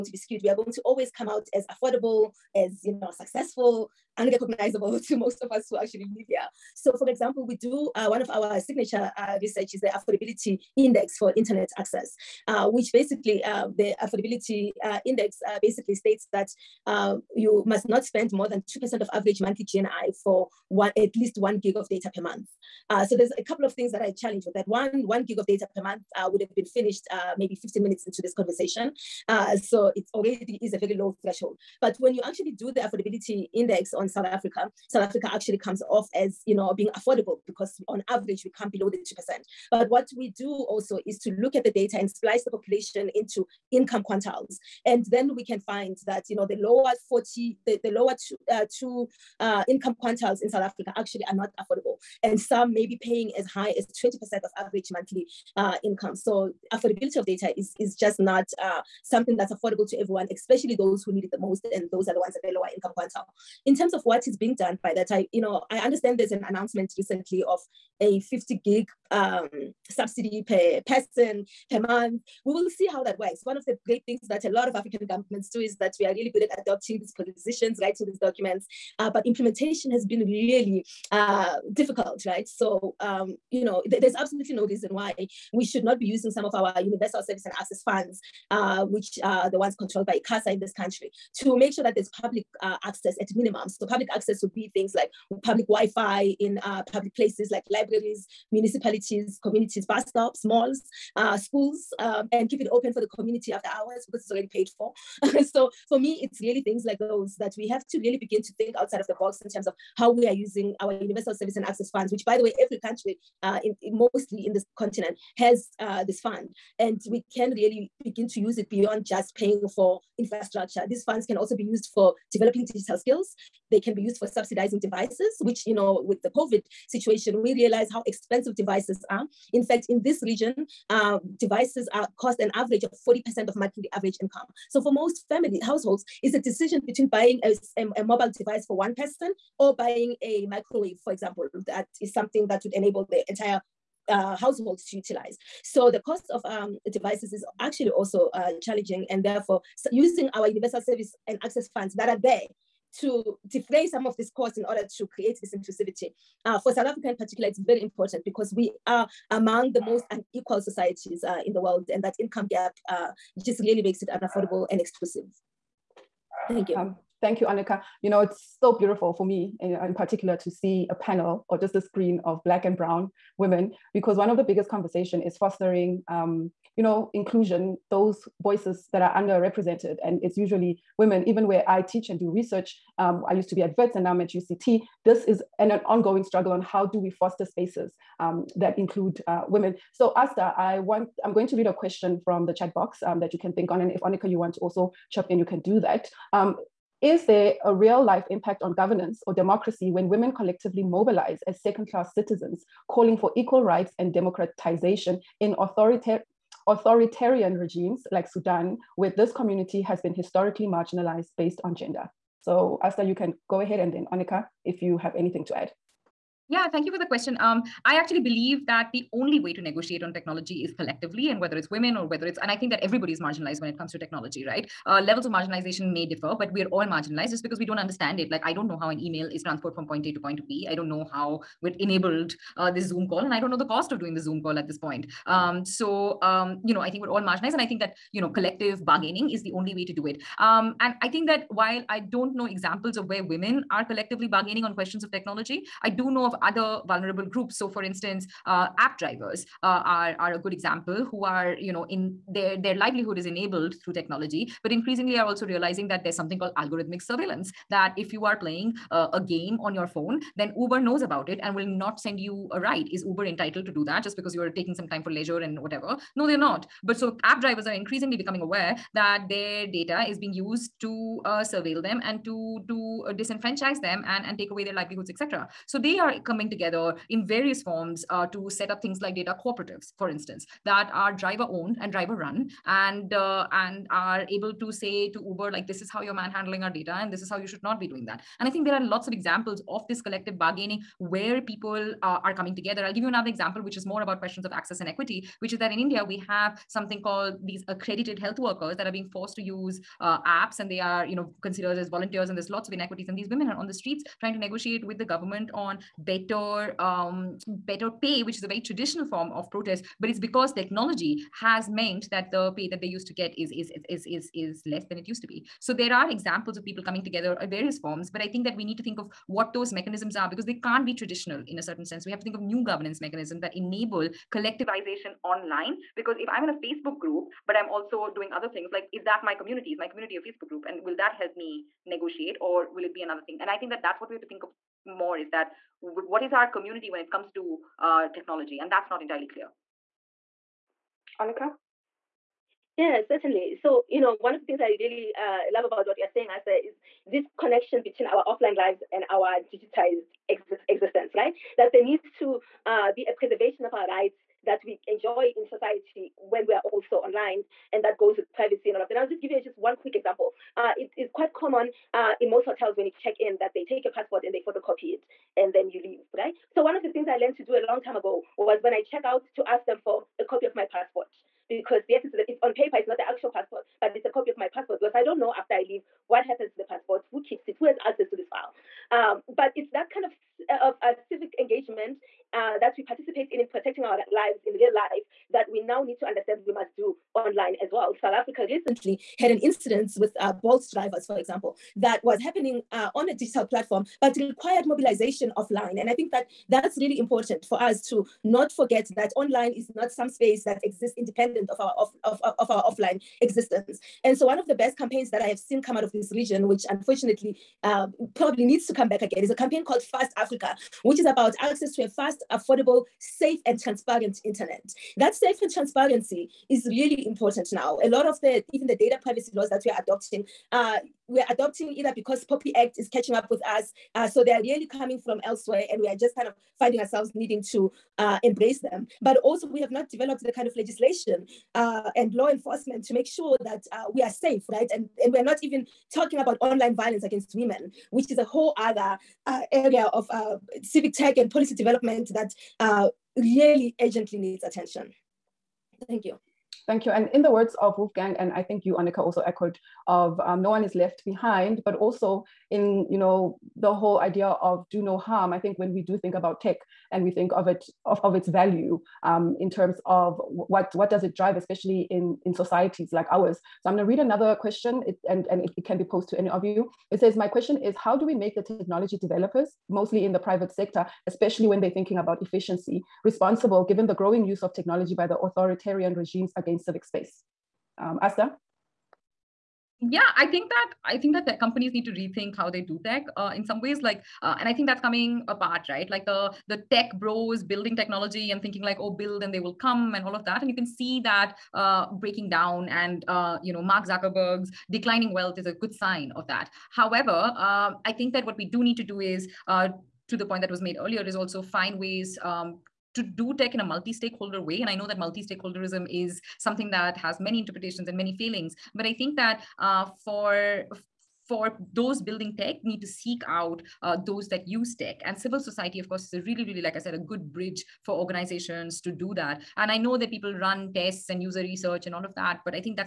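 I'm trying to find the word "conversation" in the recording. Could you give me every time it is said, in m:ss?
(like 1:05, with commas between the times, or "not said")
0:28, 2:54.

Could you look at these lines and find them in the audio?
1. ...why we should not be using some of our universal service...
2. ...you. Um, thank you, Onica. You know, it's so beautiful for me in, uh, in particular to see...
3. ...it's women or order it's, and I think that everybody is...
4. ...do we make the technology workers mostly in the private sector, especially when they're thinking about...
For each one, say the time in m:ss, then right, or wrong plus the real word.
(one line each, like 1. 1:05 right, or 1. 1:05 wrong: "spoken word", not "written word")
1. 1:24 right
2. 2:46 right
3. 3:41 wrong: "whether", not "order"
4. 7:47 wrong: "developers", not "workers".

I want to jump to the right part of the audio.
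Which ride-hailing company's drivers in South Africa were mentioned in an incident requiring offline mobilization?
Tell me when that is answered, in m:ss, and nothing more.
6:30.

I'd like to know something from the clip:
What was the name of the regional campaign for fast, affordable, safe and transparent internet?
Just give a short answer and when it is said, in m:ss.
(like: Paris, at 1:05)
Fast Africa, at 6:49.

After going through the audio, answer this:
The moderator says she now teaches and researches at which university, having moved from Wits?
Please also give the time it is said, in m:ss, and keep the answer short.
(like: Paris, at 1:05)
UCT, at 3:04.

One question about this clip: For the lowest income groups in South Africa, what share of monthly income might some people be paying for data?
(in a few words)
20%.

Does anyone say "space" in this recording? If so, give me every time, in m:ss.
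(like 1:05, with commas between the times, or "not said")
3:07, 6:40, 7:56.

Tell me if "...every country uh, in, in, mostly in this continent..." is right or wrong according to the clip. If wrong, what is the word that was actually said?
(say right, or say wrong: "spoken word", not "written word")
right.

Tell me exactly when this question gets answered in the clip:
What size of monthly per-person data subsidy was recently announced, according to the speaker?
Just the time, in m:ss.
1:08.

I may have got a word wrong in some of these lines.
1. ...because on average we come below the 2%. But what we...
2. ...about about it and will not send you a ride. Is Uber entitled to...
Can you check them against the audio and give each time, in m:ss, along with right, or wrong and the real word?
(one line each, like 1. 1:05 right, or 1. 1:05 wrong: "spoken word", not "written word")
1. 0:37 right
2. 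4:21 right.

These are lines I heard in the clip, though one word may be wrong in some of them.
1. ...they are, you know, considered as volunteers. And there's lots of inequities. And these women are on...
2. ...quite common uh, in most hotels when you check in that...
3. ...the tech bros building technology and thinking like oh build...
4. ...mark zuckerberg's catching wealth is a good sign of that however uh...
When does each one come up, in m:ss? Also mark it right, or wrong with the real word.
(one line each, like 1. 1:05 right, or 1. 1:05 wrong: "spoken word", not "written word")
1. 5:00 right
2. 6:01 right
3. 8:06 right
4. 8:13 wrong: "declining", not "catching".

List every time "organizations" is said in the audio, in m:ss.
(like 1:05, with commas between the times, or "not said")
8:37.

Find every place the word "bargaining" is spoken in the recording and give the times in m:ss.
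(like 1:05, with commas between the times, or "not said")
3:58, 4:04, 4:50.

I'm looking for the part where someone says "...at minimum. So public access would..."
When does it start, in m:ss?
1:33.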